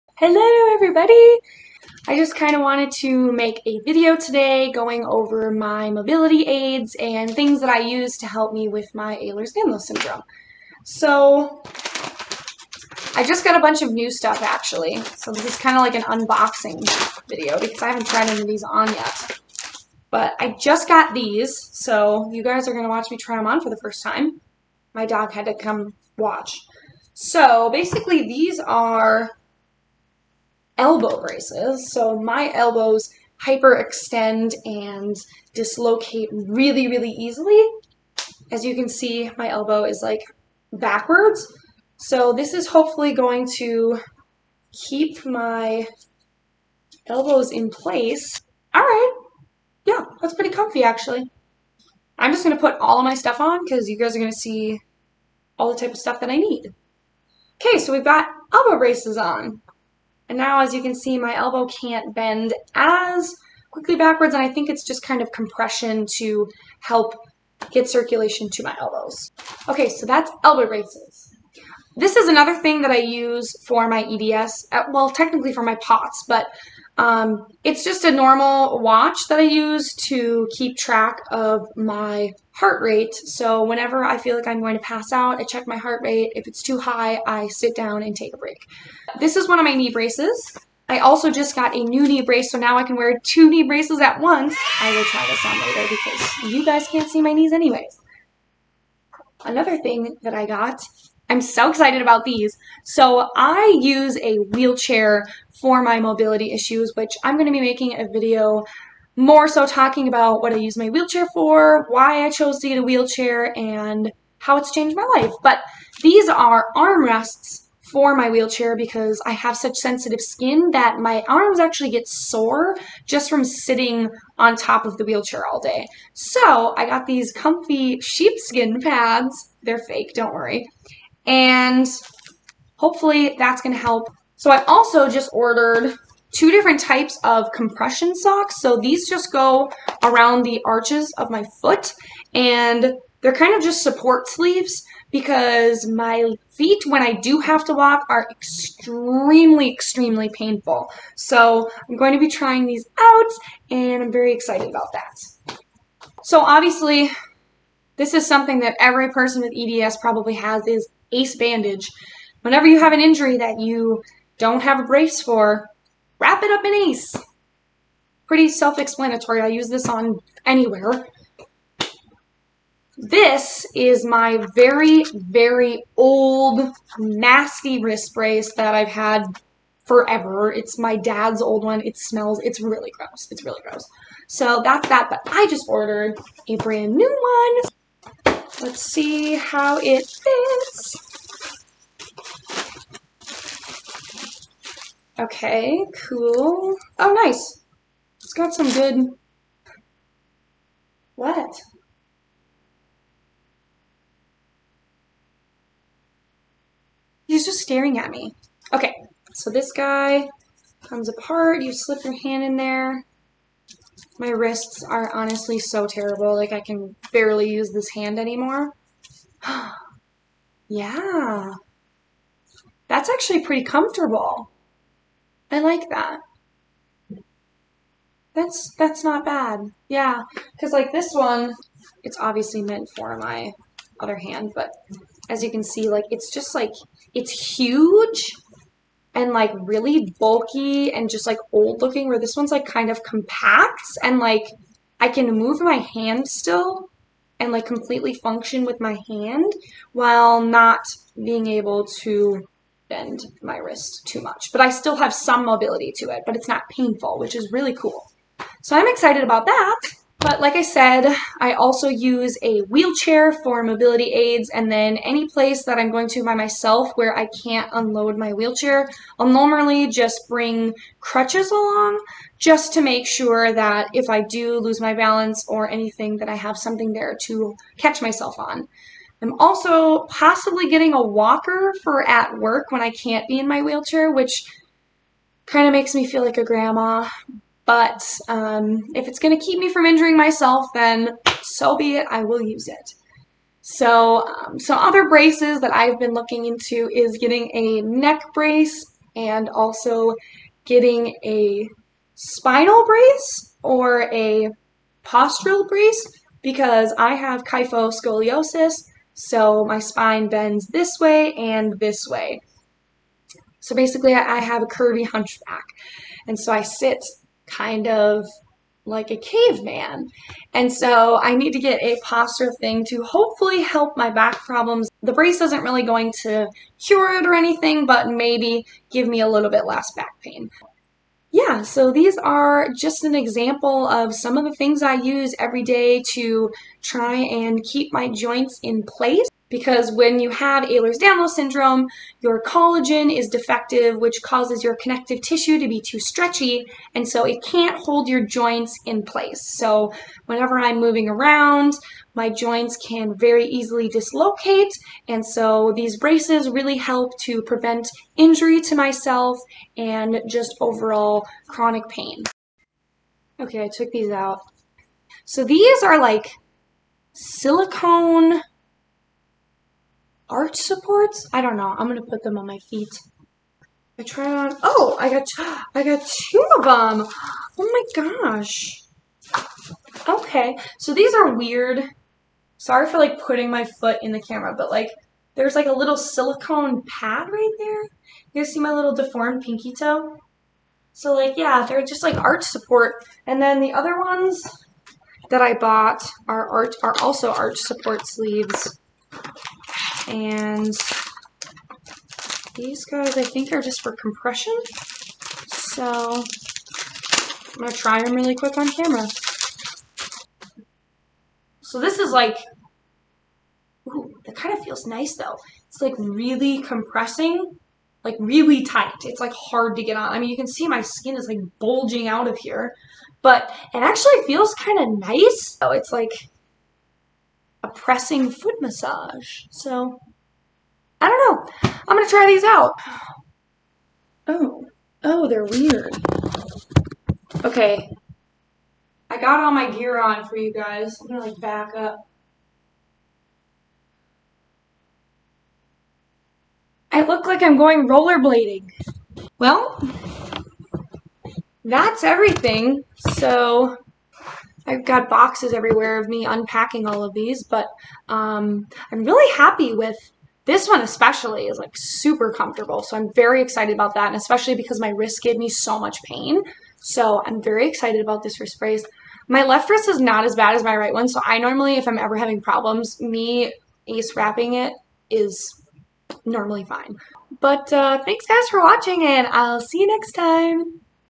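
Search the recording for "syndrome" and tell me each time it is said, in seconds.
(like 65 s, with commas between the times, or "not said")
9 s, 341 s.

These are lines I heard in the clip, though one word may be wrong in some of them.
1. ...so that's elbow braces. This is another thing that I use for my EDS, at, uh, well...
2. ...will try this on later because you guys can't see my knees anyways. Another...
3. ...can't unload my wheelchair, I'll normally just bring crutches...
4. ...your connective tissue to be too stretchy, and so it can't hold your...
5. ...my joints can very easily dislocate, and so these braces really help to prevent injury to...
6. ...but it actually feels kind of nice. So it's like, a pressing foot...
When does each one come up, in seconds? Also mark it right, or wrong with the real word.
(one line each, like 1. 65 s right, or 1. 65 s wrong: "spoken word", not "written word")
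1. 69 s right
2. 94 s right
3. 267 s right
4. 344 s right
5. 352 s right
6. 423 s right.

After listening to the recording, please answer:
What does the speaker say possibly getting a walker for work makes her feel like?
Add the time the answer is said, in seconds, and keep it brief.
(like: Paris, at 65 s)
A grandma, at 286 s.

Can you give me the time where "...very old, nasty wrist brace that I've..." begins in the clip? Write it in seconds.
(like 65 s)
175 s.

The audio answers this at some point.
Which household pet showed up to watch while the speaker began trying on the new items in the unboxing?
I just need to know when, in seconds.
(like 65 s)
24 s.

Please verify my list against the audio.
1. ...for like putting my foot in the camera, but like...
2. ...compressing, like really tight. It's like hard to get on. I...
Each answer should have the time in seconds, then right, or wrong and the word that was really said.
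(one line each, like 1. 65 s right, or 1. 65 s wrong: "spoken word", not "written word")
1. 382 s right
2. 416 s right.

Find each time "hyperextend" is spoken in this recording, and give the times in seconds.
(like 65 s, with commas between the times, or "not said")
33 s.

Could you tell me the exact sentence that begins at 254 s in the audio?
But I still have some mobility to it, but it's not painful, which is really cool.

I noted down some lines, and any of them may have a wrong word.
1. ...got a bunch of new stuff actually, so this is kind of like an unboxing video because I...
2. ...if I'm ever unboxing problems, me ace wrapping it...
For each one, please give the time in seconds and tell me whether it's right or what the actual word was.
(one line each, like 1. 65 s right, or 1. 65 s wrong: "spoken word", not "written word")
1. 13 s right
2. 471 s wrong: "having", not "unboxing".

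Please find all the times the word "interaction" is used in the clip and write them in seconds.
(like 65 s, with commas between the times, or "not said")
not said.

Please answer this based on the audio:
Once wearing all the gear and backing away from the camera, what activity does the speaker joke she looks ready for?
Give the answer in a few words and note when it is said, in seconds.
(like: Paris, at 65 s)
Rollerblading, at 447 s.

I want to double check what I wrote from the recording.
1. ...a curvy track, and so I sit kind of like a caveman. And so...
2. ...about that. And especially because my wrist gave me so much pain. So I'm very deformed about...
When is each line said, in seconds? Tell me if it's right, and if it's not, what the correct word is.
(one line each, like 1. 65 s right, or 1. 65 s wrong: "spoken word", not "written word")
1. 314 s wrong: "hunchback", not "track"
2. 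463 s wrong: "excited", not "deformed".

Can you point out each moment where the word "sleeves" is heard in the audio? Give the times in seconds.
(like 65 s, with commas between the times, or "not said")
144 s, 398 s.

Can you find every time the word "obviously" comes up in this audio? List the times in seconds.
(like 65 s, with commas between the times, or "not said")
156 s, 232 s.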